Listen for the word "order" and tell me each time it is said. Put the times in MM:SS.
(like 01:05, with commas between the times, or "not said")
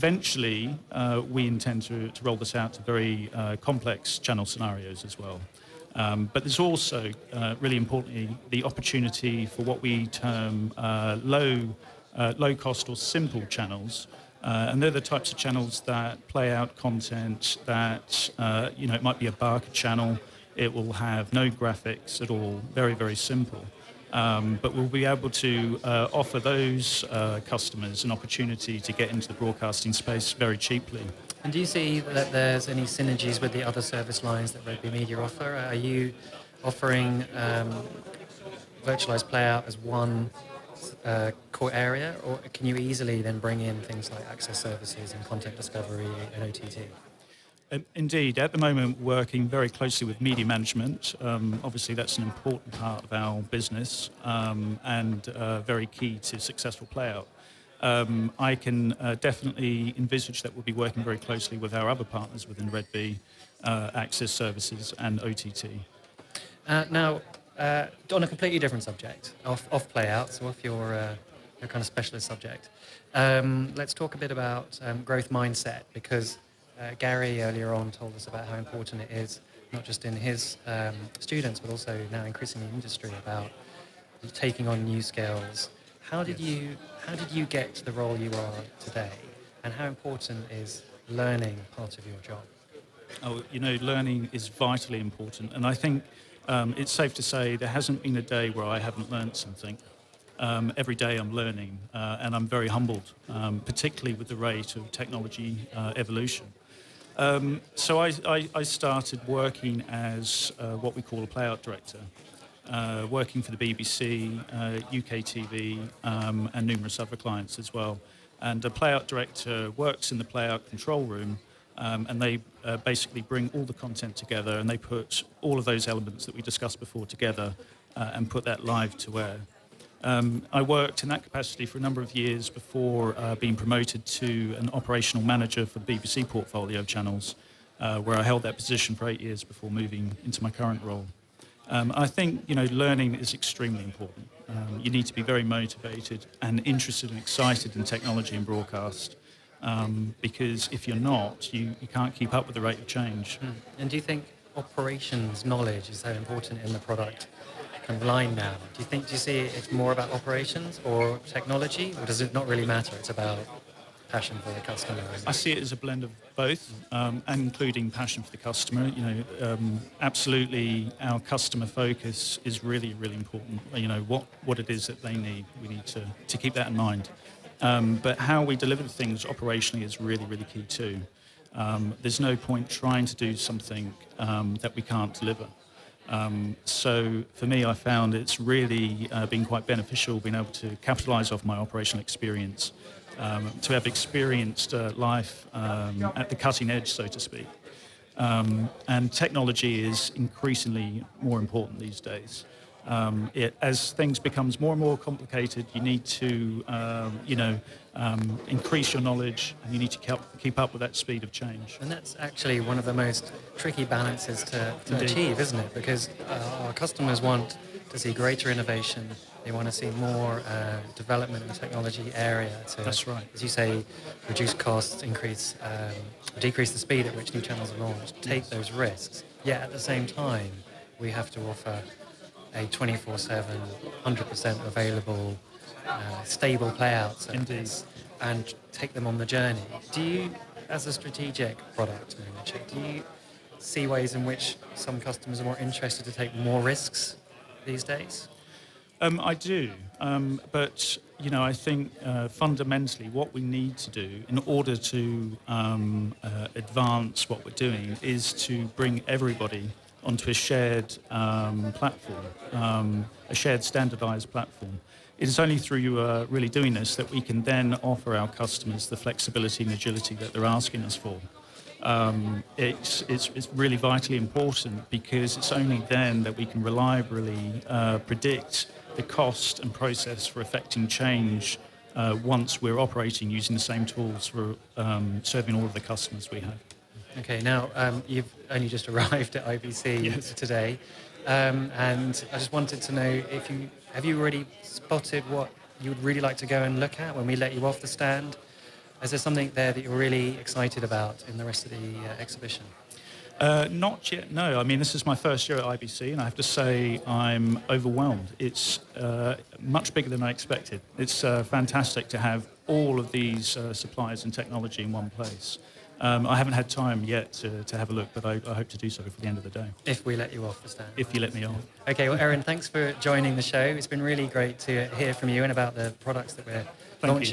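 04:14.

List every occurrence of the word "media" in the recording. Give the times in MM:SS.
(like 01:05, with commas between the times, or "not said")
00:34, 00:50.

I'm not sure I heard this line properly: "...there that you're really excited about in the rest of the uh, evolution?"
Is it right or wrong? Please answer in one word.
wrong.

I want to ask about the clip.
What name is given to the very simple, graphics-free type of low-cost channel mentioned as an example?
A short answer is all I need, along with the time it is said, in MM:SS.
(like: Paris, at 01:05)
Barker channel, at 00:19.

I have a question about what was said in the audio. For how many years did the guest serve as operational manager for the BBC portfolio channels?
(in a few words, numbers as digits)
8.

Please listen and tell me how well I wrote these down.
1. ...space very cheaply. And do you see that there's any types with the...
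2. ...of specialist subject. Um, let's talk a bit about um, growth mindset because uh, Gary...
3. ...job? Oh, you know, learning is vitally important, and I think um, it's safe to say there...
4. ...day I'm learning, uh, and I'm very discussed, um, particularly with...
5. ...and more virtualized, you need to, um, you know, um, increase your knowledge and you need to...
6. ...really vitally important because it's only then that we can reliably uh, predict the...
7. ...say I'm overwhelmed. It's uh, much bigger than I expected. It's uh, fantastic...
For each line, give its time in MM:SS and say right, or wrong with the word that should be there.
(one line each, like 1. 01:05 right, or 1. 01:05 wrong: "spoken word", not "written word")
1. 00:29 wrong: "synergies", not "types"
2. 01:11 right
3. 01:32 right
4. 01:40 wrong: "humbled", not "discussed"
5. 03:24 wrong: "complicated", not "virtualized"
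6. 04:33 right
7. 05:06 right.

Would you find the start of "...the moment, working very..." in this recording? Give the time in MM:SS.
00:48.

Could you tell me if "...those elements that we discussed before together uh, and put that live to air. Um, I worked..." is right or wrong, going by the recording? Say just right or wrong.
right.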